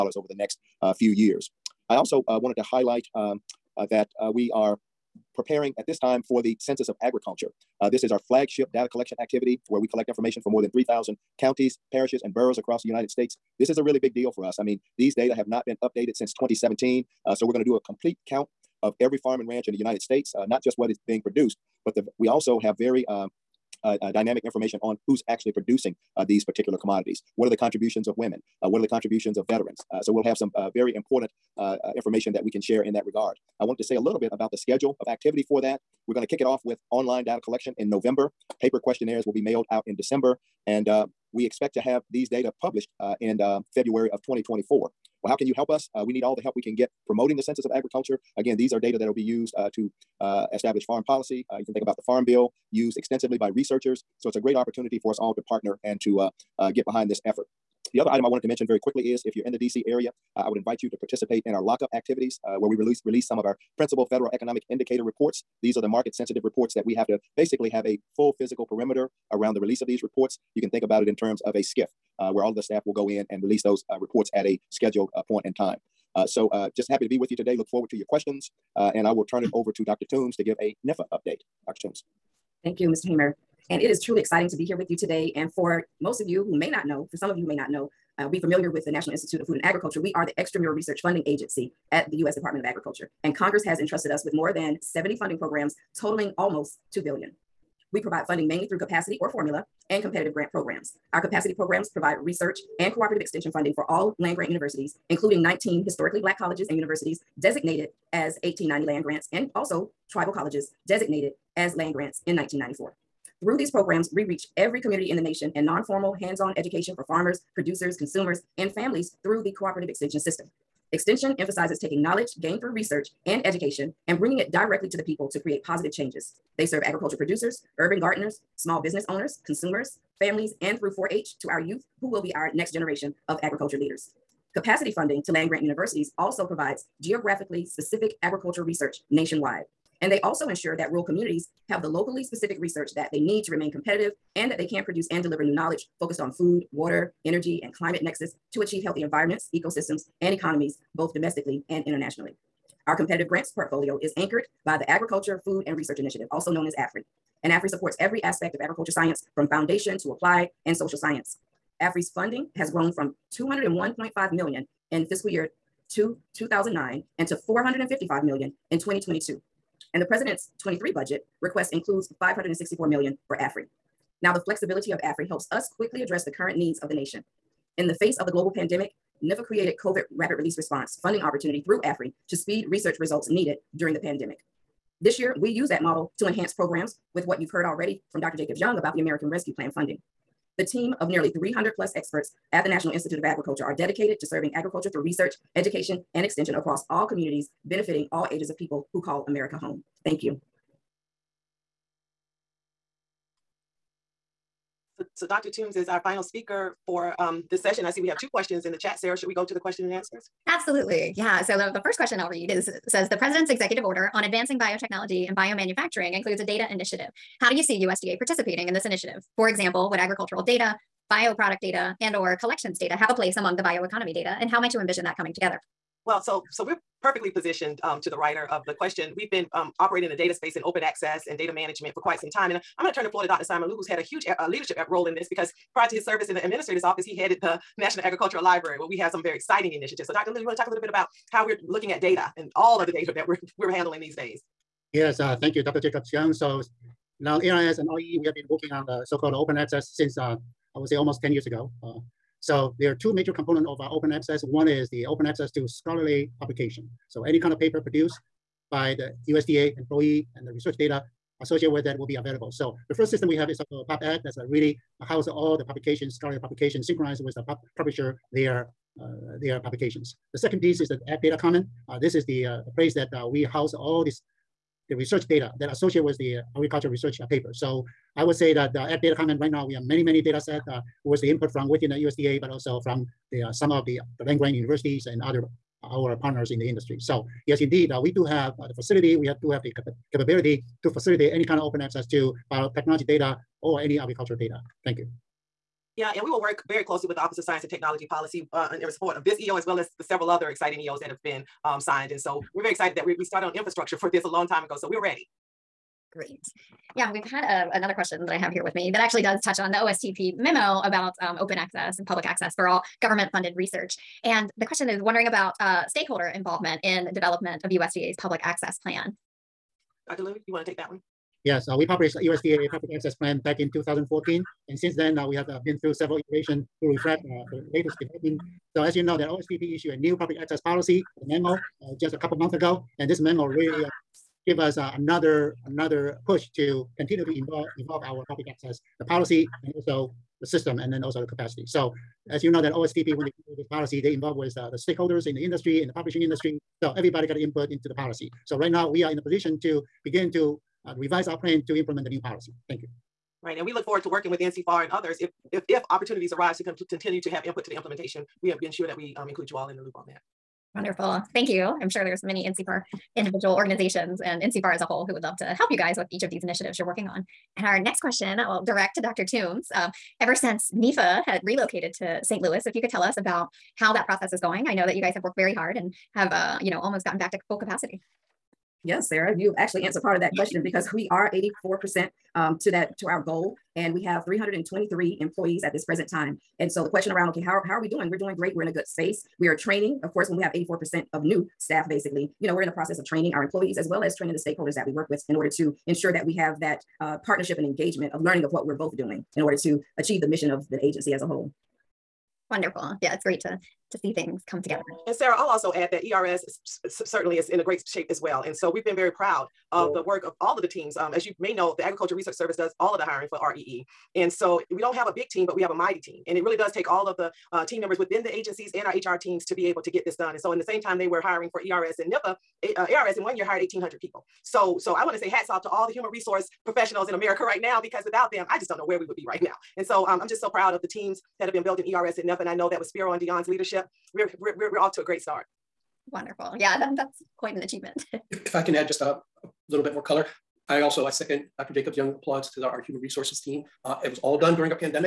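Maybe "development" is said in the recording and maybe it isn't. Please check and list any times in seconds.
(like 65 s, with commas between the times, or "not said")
317 s, 328 s.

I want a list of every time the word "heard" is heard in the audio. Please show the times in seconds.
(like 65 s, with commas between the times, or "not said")
187 s.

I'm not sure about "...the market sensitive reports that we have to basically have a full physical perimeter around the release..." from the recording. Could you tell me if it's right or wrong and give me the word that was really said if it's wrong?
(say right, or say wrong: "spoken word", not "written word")
right.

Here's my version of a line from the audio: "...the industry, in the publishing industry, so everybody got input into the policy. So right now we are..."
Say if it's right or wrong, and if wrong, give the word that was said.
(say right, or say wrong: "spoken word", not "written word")
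right.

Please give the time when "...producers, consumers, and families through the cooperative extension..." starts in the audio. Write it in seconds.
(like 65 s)
117 s.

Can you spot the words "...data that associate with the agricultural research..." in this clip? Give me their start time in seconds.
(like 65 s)
275 s.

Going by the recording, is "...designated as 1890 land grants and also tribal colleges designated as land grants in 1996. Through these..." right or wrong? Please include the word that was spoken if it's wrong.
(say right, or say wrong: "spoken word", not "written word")
wrong: "1994", not "1996".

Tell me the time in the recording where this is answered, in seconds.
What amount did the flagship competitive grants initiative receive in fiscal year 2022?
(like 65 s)
167 s.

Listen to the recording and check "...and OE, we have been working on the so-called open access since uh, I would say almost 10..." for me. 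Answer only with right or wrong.
right.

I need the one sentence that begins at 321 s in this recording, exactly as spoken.
Yes, uh, we published the USDA public access plan back in 2014.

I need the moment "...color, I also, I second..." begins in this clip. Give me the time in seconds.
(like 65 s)
440 s.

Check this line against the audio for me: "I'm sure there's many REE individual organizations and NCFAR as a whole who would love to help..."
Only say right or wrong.
wrong.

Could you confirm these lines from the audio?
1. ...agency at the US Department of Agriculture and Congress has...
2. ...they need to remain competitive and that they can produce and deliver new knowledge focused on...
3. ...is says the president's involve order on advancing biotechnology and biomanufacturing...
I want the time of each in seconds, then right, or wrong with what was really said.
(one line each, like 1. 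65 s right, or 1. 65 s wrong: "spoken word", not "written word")
1. 91 s right
2. 143 s right
3. 212 s wrong: "executive", not "involve".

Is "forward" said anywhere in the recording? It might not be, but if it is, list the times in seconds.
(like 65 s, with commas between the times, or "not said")
77 s, 353 s.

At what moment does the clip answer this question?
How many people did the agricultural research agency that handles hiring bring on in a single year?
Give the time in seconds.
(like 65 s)
423 s.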